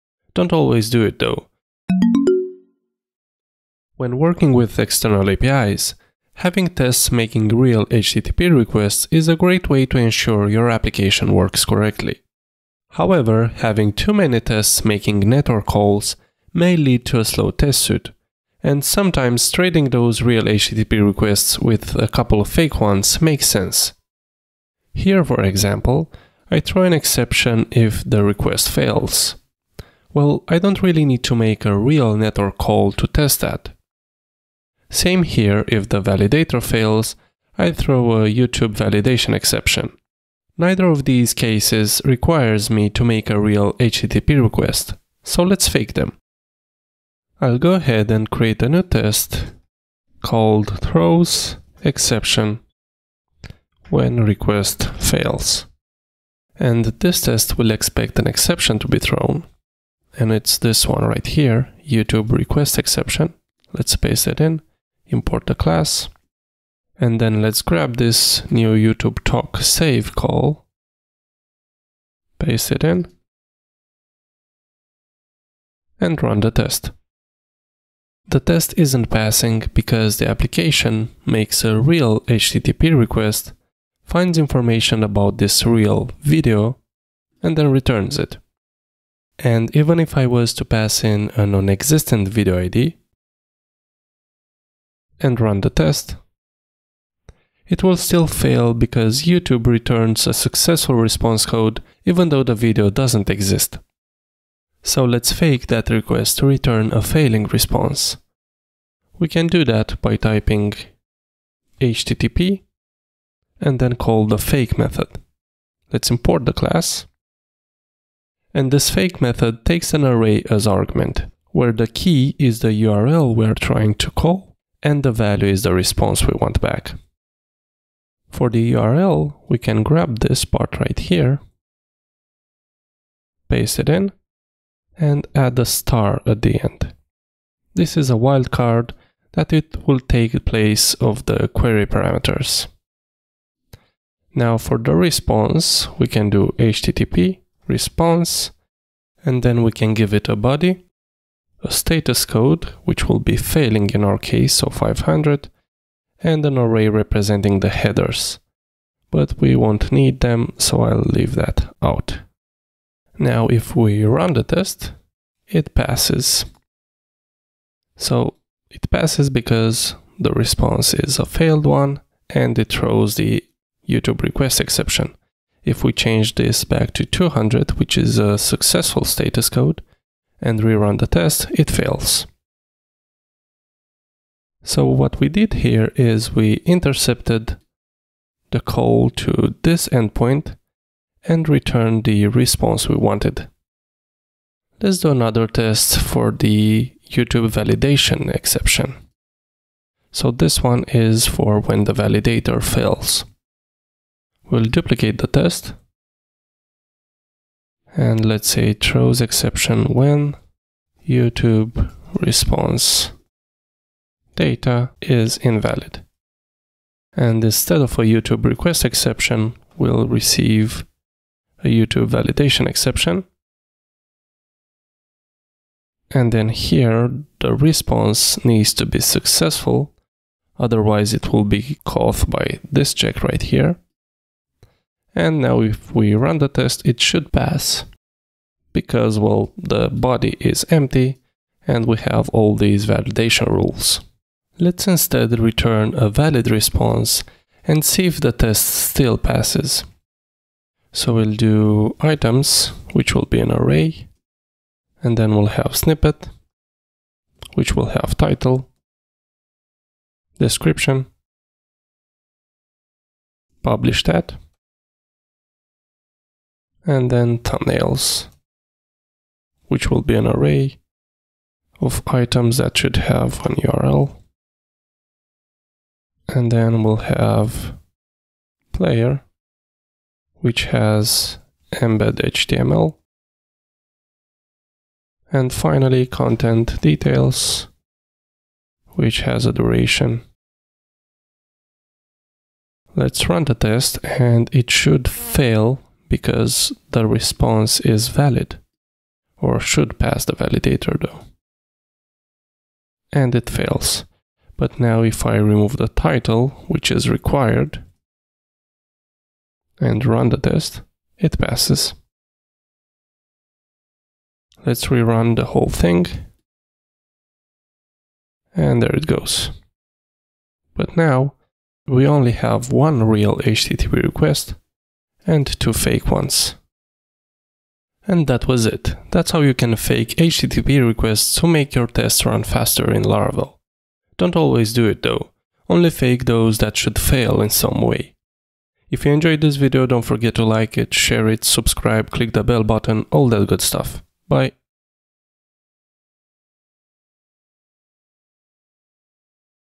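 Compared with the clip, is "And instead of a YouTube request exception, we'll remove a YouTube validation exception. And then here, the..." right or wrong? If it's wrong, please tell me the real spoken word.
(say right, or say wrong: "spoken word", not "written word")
wrong: "receive", not "remove".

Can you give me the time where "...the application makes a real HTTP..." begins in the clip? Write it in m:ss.
1:20.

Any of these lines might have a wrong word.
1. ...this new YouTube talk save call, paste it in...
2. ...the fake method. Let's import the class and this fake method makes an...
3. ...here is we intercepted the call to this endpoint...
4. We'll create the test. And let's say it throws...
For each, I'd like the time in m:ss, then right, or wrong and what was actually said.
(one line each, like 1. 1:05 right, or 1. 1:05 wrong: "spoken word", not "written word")
1. 1:07 right
2. 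1:54 wrong: "takes", not "makes"
3. 3:05 right
4. 3:24 wrong: "duplicate", not "create".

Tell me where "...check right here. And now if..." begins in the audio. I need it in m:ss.
3:52.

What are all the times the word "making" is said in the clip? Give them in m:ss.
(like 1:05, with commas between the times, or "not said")
0:07, 0:14.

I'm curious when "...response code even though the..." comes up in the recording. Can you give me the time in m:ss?
1:40.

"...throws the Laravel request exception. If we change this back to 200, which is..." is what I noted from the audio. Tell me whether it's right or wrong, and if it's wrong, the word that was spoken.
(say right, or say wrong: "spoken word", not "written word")
wrong: "YouTube", not "Laravel".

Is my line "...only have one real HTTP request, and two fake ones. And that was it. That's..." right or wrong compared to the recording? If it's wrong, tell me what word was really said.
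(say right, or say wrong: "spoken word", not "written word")
right.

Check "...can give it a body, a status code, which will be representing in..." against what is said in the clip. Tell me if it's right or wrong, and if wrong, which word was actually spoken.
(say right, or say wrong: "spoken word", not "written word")
wrong: "failing", not "representing".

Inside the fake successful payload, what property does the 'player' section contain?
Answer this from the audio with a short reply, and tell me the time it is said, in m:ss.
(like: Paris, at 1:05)
embed HTML, at 4:41.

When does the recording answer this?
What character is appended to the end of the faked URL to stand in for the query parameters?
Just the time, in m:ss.
2:15.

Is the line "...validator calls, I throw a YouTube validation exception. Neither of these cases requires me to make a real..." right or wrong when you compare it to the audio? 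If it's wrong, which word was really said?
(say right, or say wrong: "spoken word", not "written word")
wrong: "fails", not "calls".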